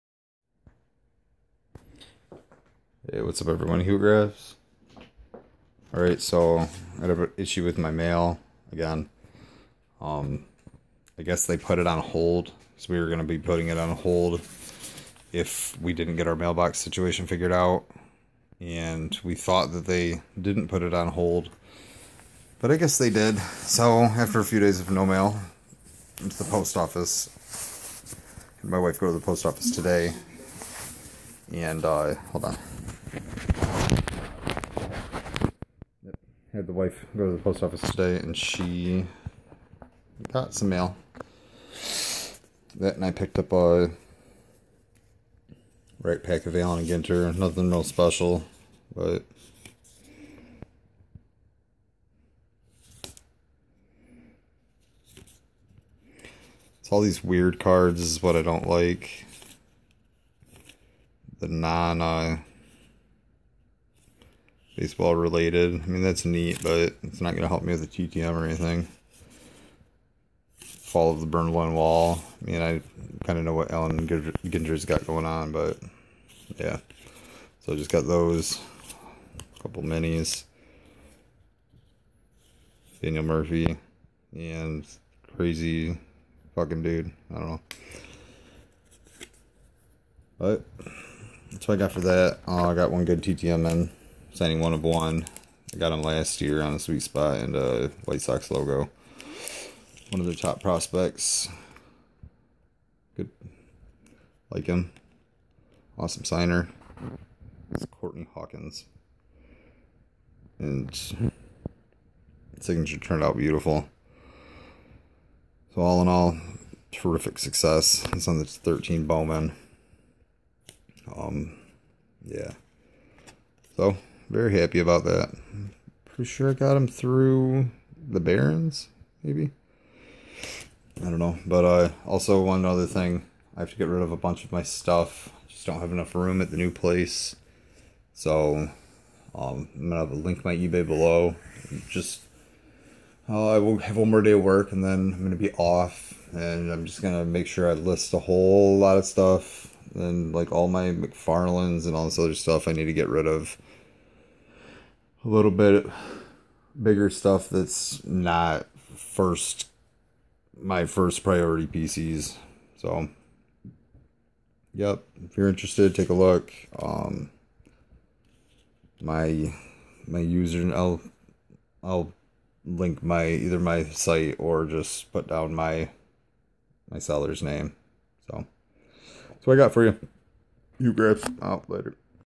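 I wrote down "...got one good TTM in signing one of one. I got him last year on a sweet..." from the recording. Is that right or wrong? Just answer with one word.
right.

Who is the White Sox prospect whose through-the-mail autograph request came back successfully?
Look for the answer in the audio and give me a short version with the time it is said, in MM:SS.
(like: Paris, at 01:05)
Courtney Hawkins, at 01:47.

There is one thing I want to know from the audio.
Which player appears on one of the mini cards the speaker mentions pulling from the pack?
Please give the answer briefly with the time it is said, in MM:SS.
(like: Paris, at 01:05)
Daniel Murphy, at 01:23.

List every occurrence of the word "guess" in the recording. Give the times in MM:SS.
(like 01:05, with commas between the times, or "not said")
00:11, 00:22.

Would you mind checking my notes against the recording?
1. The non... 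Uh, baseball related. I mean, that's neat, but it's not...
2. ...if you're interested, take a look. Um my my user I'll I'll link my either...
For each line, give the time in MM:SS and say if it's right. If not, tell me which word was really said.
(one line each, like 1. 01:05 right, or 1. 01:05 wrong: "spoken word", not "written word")
1. 01:01 right
2. 02:45 right.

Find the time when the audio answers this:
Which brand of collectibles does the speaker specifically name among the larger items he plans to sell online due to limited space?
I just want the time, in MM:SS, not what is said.
02:30.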